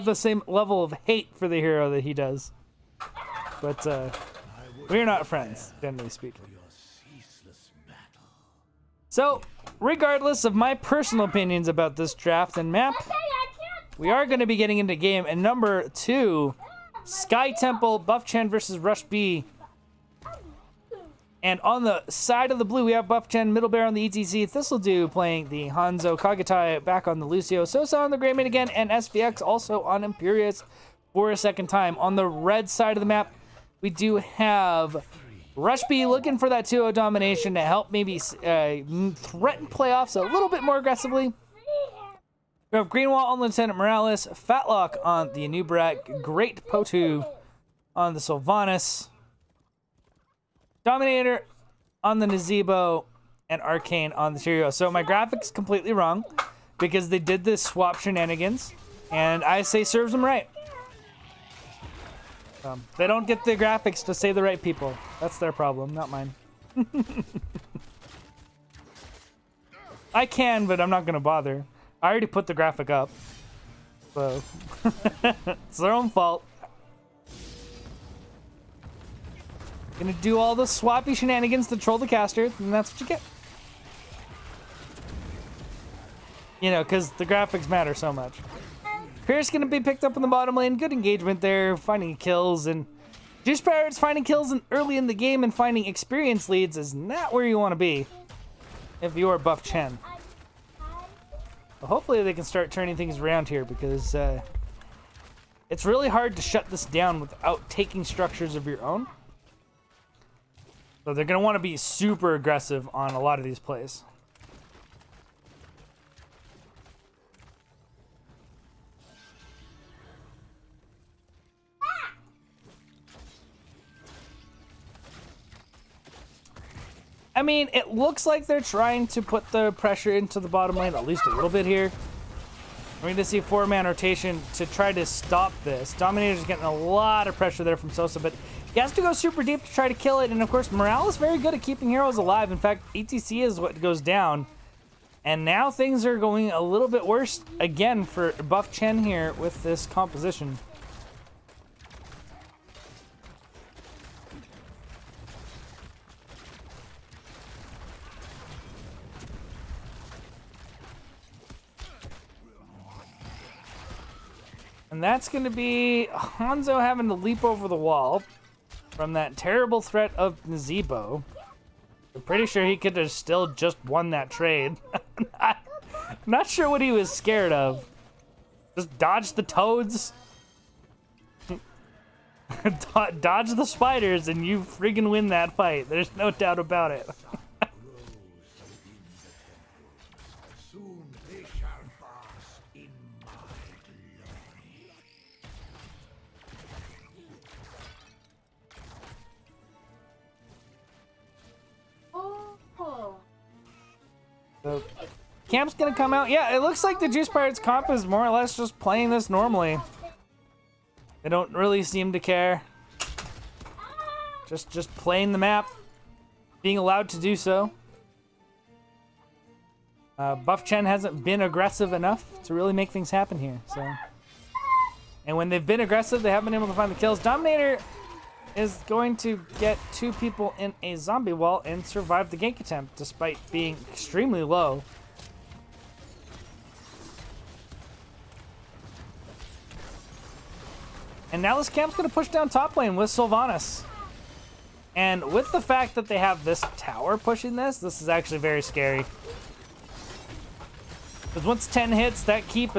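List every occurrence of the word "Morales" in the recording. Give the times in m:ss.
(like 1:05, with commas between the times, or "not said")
0:43, 2:20.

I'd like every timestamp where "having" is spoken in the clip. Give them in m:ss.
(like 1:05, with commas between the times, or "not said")
2:46.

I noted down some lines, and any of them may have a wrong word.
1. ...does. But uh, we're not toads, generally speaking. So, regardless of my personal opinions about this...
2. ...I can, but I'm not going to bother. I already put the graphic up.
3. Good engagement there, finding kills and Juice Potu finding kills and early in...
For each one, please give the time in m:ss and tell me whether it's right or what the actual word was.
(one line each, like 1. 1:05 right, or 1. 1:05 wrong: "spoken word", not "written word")
1. 0:02 wrong: "friends", not "toads"
2. 1:10 right
3. 1:30 wrong: "Pirates", not "Potu".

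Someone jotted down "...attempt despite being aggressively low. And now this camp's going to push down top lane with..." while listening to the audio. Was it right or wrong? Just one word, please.
wrong.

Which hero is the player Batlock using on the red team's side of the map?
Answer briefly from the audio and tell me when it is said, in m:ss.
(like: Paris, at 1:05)
Anub'arak, at 0:45.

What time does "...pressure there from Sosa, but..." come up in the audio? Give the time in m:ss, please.
2:17.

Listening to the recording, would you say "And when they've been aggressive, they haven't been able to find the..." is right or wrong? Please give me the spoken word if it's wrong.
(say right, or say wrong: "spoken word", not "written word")
right.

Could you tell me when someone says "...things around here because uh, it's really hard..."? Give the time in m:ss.
1:42.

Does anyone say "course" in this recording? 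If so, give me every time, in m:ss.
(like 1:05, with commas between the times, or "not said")
2:20.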